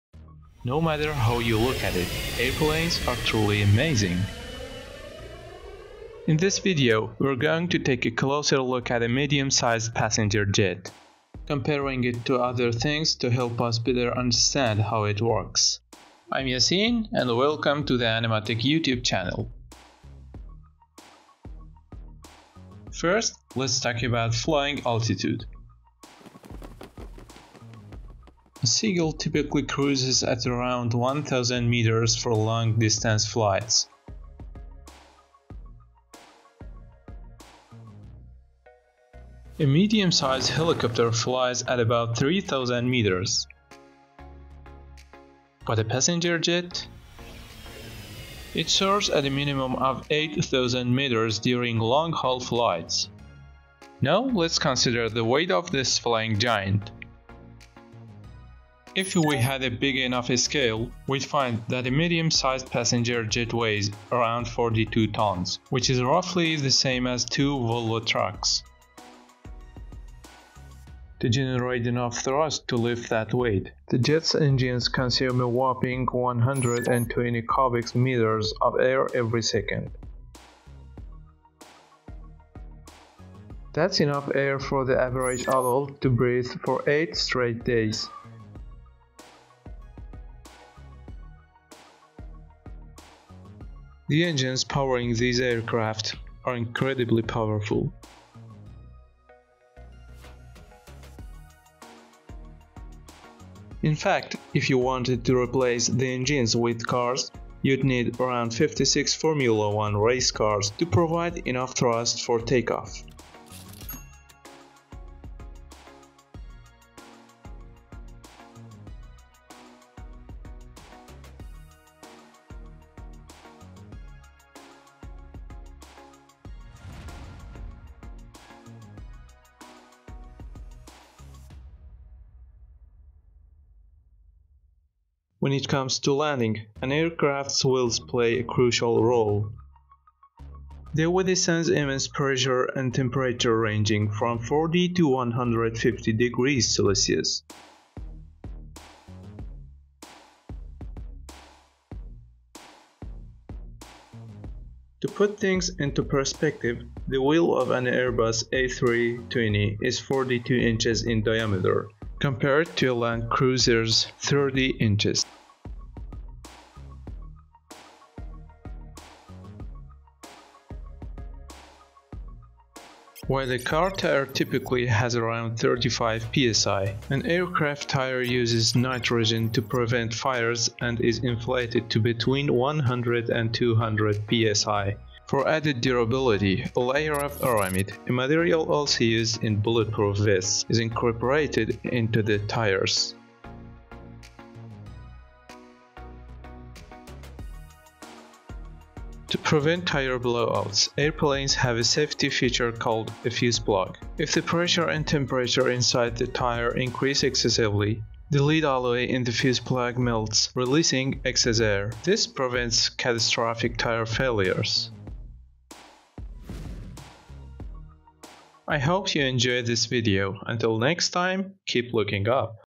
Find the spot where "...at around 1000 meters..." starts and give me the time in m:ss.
0:30.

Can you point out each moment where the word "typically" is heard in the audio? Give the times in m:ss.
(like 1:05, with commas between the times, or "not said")
0:29, 2:54.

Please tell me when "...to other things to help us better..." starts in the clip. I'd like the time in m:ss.
0:12.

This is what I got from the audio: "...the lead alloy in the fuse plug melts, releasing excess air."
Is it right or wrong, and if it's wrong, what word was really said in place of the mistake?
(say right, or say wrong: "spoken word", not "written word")
right.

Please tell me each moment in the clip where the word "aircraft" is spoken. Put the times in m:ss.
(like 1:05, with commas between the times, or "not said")
1:35, 2:16, 2:57.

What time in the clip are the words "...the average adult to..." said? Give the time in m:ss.
1:24.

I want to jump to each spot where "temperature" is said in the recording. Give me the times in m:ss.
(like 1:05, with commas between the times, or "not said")
2:22, 3:25.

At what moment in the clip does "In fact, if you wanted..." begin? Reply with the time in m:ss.
1:43.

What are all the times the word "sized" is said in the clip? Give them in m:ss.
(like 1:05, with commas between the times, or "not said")
0:09, 0:39, 1:01.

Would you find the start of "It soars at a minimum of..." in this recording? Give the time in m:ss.
0:48.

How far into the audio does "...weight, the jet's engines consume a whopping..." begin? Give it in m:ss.
1:13.